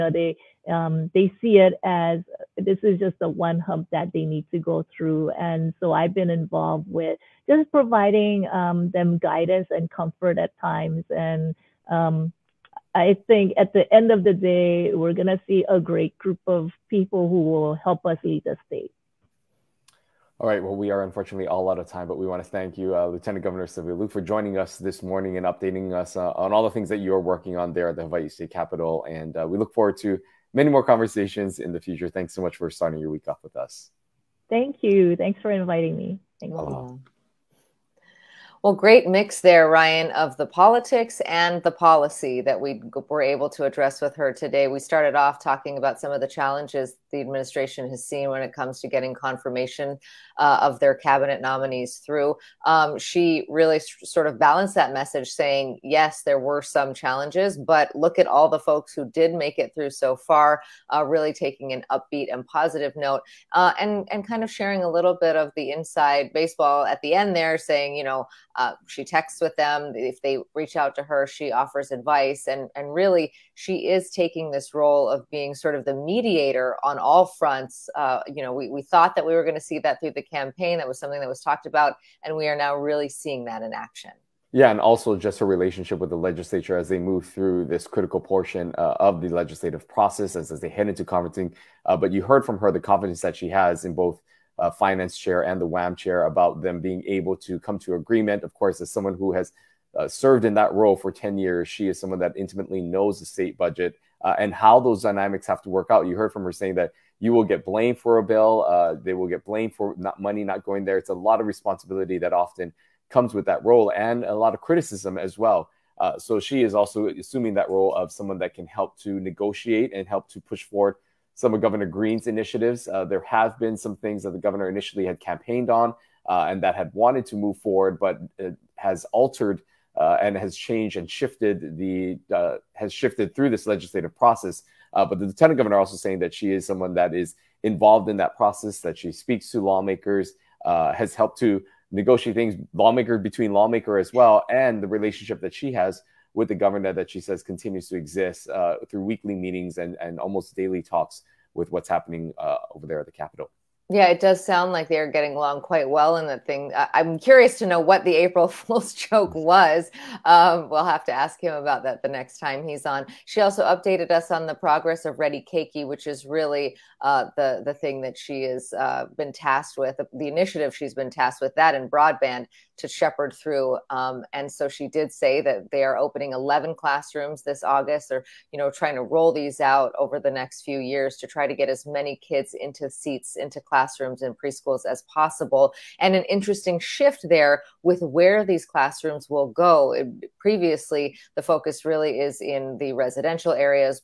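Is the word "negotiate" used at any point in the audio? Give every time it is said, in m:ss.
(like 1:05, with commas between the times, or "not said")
1:59, 2:21.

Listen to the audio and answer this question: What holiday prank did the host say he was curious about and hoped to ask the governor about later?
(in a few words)
April Fool's joke.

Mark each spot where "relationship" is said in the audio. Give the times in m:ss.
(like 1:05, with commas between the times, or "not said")
1:25, 2:24.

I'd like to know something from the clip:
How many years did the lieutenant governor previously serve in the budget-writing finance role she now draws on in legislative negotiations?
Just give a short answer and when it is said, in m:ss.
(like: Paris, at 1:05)
10, at 1:41.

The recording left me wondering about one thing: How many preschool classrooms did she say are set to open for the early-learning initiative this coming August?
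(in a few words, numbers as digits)
11.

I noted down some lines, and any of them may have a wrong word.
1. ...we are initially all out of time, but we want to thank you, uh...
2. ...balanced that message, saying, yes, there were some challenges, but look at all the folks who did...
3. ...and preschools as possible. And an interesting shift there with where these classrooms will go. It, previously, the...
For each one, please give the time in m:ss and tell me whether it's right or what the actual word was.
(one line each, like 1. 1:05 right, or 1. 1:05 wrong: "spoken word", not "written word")
1. 0:20 wrong: "unfortunately", not "initially"
2. 0:54 right
3. 3:04 right.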